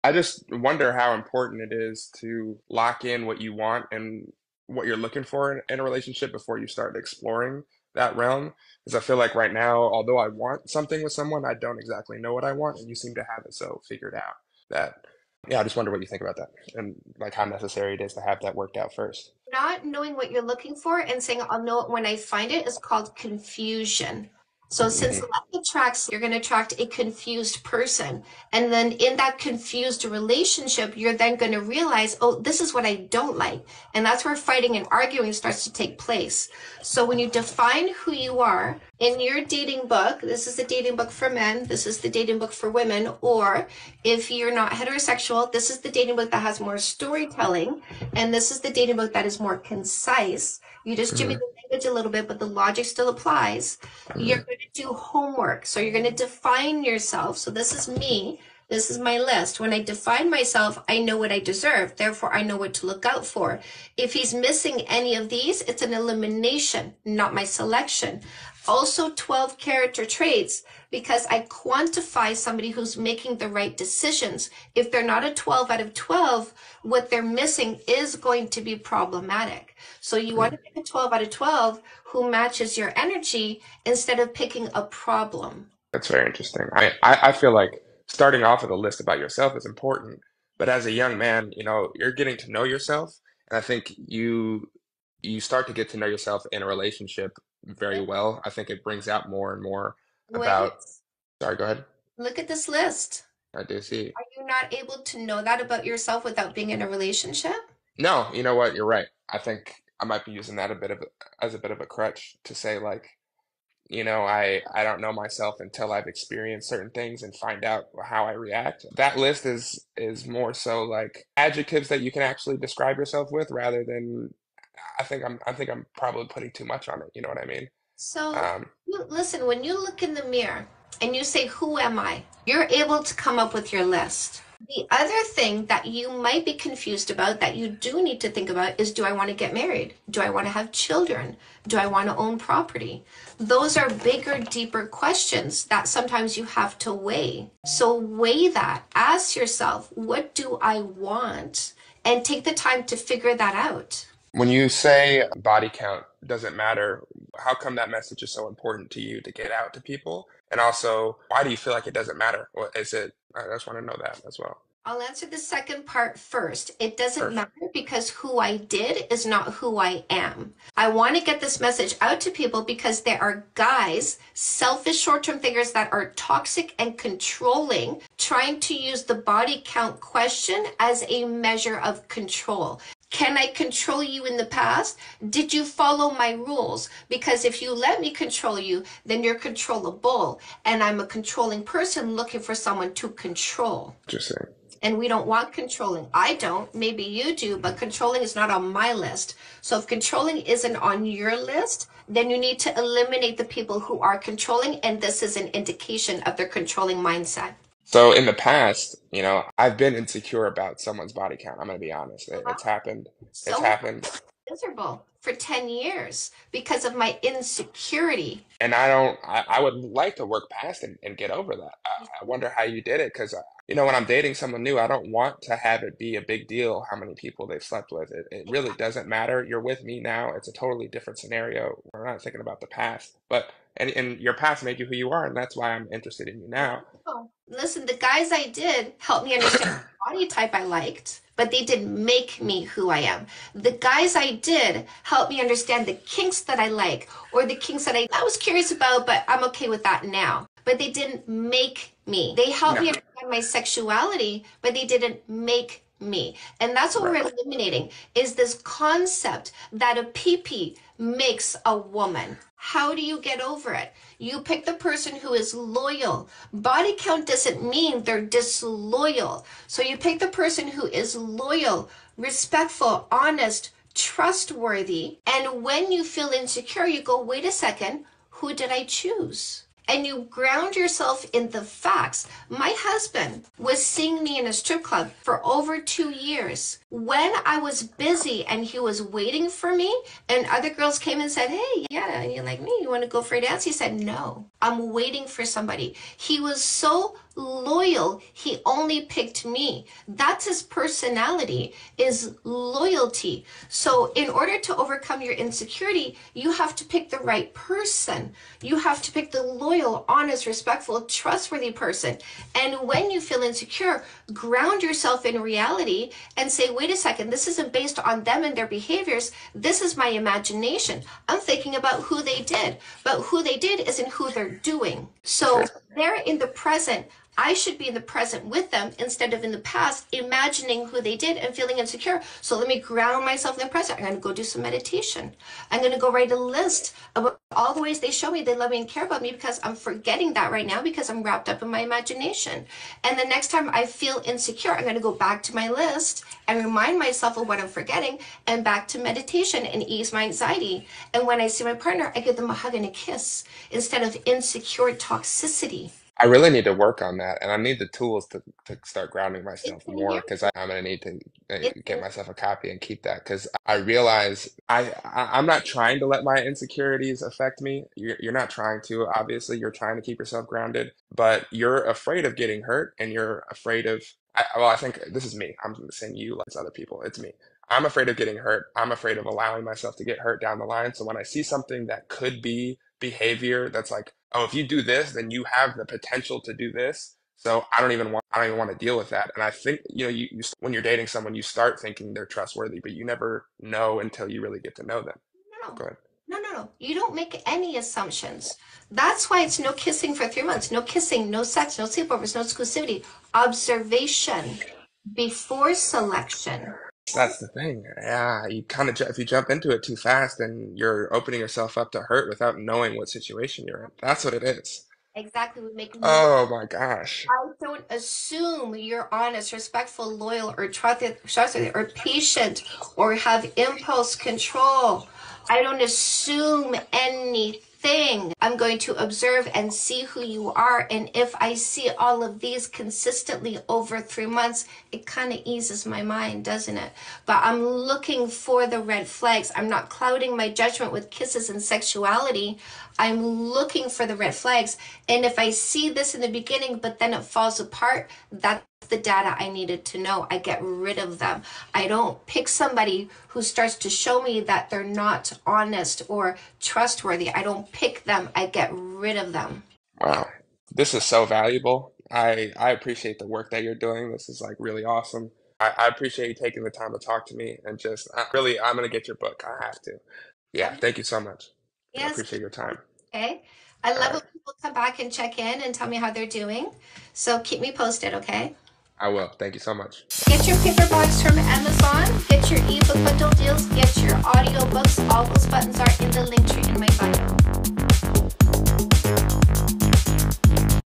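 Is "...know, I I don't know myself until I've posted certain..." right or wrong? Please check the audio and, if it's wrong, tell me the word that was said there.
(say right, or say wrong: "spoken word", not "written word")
wrong: "experienced", not "posted".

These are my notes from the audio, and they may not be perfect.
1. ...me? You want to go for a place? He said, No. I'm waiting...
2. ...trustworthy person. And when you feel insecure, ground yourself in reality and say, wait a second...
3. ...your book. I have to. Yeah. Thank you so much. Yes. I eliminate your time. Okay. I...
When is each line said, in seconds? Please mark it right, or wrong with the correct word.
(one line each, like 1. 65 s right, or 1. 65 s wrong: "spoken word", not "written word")
1. 292 s wrong: "dance", not "place"
2. 311 s right
3. 469 s wrong: "appreciate", not "eliminate".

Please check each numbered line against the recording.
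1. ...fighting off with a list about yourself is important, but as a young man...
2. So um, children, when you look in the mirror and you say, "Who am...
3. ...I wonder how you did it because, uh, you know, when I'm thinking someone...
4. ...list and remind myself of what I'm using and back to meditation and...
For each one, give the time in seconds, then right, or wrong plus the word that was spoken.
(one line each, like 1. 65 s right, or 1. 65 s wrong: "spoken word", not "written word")
1. 88 s wrong: "starting", not "fighting"
2. 127 s wrong: "listen", not "children"
3. 222 s wrong: "dating", not "thinking"
4. 345 s wrong: "forgetting", not "using".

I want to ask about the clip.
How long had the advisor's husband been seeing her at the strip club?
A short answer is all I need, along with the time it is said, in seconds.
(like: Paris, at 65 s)
over two years, at 285 s.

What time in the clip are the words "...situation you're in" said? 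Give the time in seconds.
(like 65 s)
413 s.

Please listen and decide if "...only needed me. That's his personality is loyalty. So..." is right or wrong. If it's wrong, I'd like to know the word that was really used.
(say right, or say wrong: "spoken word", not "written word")
wrong: "picked", not "needed".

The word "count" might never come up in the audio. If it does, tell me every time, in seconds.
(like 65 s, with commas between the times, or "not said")
155 s, 179 s, 211 s, 266 s.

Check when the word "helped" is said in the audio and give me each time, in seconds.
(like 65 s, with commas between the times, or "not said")
238 s, 245 s, 252 s.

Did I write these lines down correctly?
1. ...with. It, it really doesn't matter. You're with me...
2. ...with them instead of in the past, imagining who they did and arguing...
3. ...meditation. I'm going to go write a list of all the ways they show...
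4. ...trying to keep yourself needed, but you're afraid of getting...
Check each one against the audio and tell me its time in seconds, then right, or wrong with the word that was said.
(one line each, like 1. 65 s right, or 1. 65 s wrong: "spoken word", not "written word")
1. 227 s right
2. 328 s wrong: "feeling", not "arguing"
3. 334 s right
4. 369 s wrong: "grounded", not "needed".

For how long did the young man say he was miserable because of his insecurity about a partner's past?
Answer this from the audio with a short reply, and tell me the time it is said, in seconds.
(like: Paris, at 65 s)
10 years, at 215 s.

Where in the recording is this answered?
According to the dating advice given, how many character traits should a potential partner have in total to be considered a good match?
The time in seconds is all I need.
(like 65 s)
69 s.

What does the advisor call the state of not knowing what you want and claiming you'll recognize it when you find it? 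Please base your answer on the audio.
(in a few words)
confusion.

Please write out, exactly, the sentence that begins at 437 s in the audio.
But I'm looking for the red flags.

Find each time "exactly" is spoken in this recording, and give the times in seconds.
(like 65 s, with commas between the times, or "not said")
11 s, 415 s.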